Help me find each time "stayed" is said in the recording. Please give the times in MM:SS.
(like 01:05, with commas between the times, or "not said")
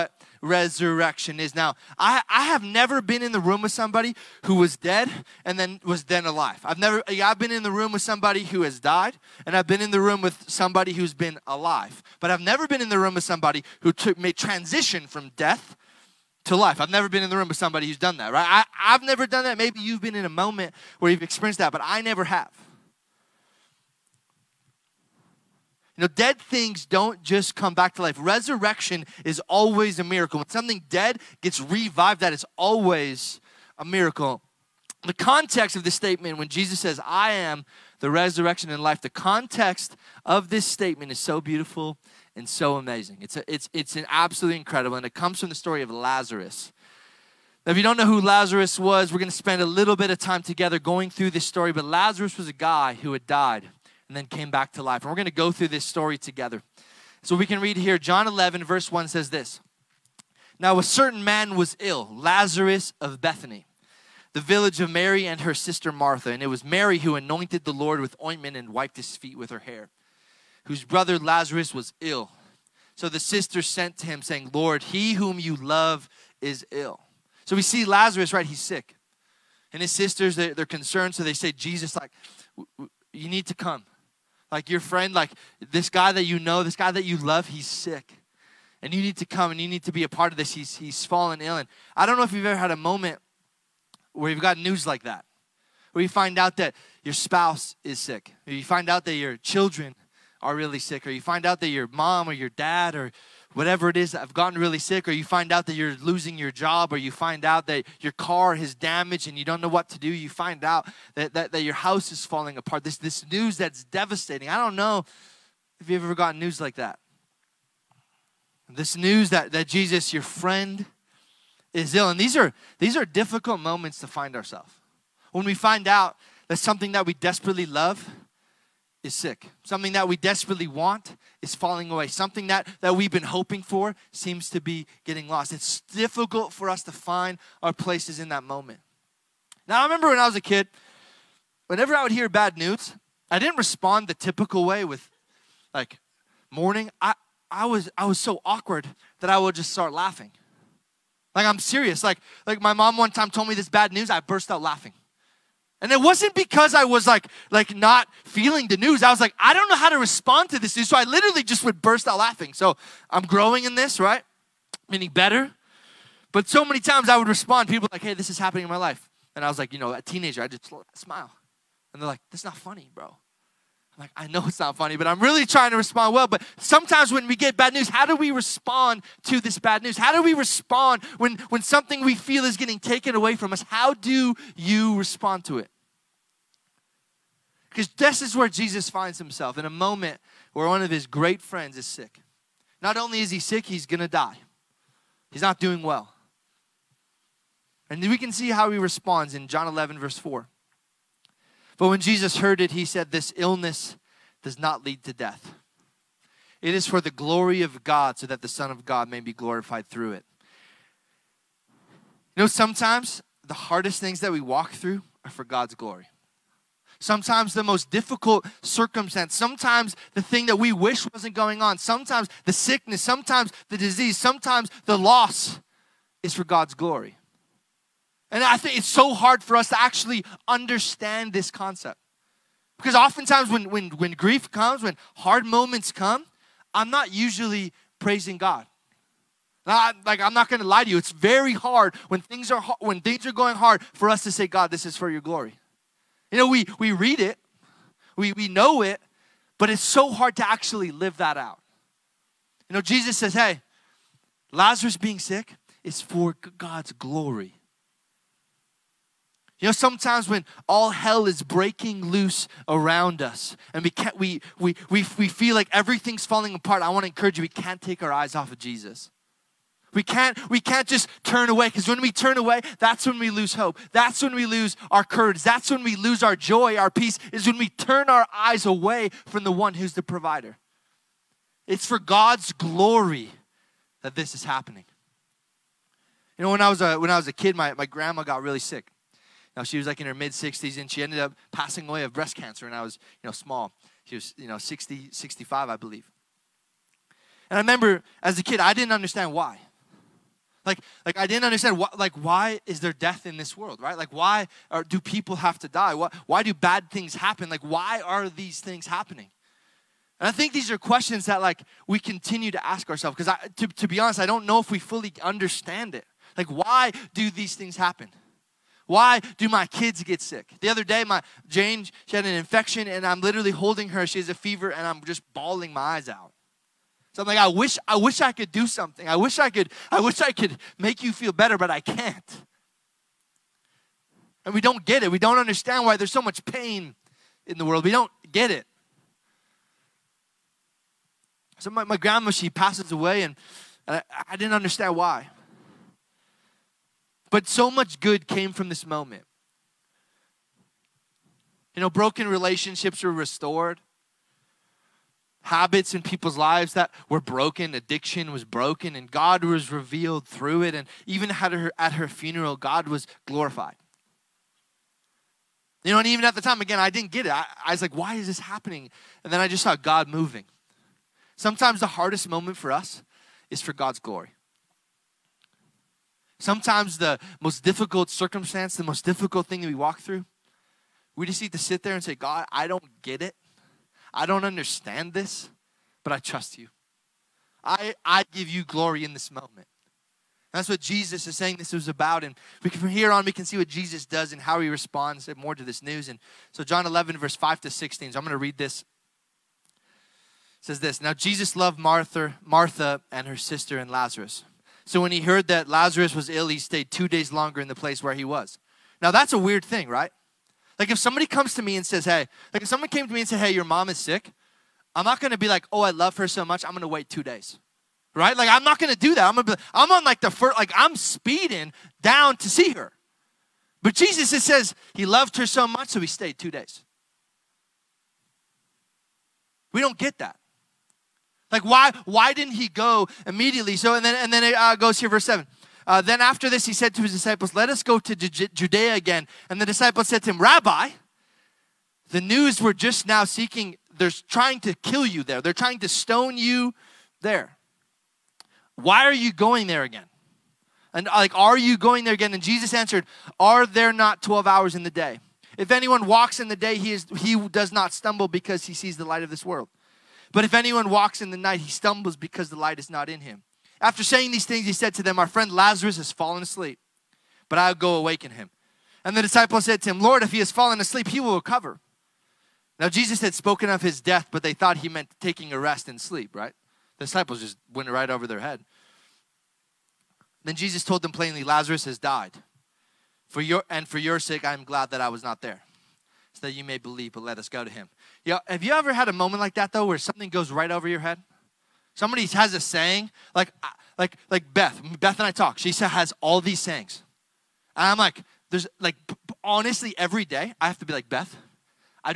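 06:46, 07:06.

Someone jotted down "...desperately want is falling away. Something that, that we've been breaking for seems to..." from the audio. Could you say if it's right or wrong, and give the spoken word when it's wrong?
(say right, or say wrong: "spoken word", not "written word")
wrong: "hoping", not "breaking".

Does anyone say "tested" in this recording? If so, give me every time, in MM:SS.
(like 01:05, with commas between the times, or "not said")
not said.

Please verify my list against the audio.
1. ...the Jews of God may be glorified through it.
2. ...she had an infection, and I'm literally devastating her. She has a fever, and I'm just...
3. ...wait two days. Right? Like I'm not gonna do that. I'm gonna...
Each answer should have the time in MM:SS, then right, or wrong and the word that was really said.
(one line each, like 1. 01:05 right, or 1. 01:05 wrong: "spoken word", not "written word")
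1. 03:28 wrong: "Son", not "Jews"
2. 05:22 wrong: "holding", not "devastating"
3. 06:56 right.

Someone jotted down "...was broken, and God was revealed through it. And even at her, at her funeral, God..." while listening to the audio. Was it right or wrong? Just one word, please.
right.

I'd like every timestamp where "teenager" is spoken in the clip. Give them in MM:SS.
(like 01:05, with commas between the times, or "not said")
02:50.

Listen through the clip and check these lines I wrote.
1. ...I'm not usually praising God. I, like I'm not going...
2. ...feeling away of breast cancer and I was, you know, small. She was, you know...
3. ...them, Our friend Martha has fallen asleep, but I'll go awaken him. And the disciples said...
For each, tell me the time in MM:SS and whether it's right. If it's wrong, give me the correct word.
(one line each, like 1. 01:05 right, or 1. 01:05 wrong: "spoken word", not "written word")
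1. 03:56 right
2. 04:51 wrong: "passing", not "feeling"
3. 07:45 wrong: "Lazarus", not "Martha".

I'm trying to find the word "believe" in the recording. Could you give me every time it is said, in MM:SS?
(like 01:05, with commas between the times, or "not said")
04:55, 08:06.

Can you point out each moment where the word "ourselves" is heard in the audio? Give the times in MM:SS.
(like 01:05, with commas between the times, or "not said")
02:04, 05:12.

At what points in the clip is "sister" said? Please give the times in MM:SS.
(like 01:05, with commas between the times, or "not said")
01:05, 01:13, 01:19, 06:43.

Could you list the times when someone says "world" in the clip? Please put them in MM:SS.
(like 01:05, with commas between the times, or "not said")
05:03, 05:37, 07:39.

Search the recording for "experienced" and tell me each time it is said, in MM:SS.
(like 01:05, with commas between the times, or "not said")
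00:21.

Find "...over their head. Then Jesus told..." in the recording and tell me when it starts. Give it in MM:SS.
07:58.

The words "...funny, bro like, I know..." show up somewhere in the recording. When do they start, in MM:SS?
02:52.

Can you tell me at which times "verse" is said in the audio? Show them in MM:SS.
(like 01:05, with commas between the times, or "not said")
00:58, 03:19, 06:37, 07:15.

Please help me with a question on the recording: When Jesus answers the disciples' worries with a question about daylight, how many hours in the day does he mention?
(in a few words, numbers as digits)
12.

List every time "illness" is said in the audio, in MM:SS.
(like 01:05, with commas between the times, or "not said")
03:23.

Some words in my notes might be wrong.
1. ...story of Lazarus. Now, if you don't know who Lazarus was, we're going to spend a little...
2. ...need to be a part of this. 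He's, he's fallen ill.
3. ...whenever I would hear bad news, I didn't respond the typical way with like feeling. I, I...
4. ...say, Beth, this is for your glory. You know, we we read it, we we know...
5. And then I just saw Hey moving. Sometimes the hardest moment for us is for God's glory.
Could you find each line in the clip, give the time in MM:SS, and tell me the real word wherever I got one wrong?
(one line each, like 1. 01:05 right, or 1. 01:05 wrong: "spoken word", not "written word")
1. 00:45 right
2. 01:29 right
3. 02:21 wrong: "mourning", not "feeling"
4. 04:04 wrong: "God", not "Beth"
5. 06:09 wrong: "God", not "Hey".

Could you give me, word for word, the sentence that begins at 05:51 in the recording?
You know, broken relationships were restored.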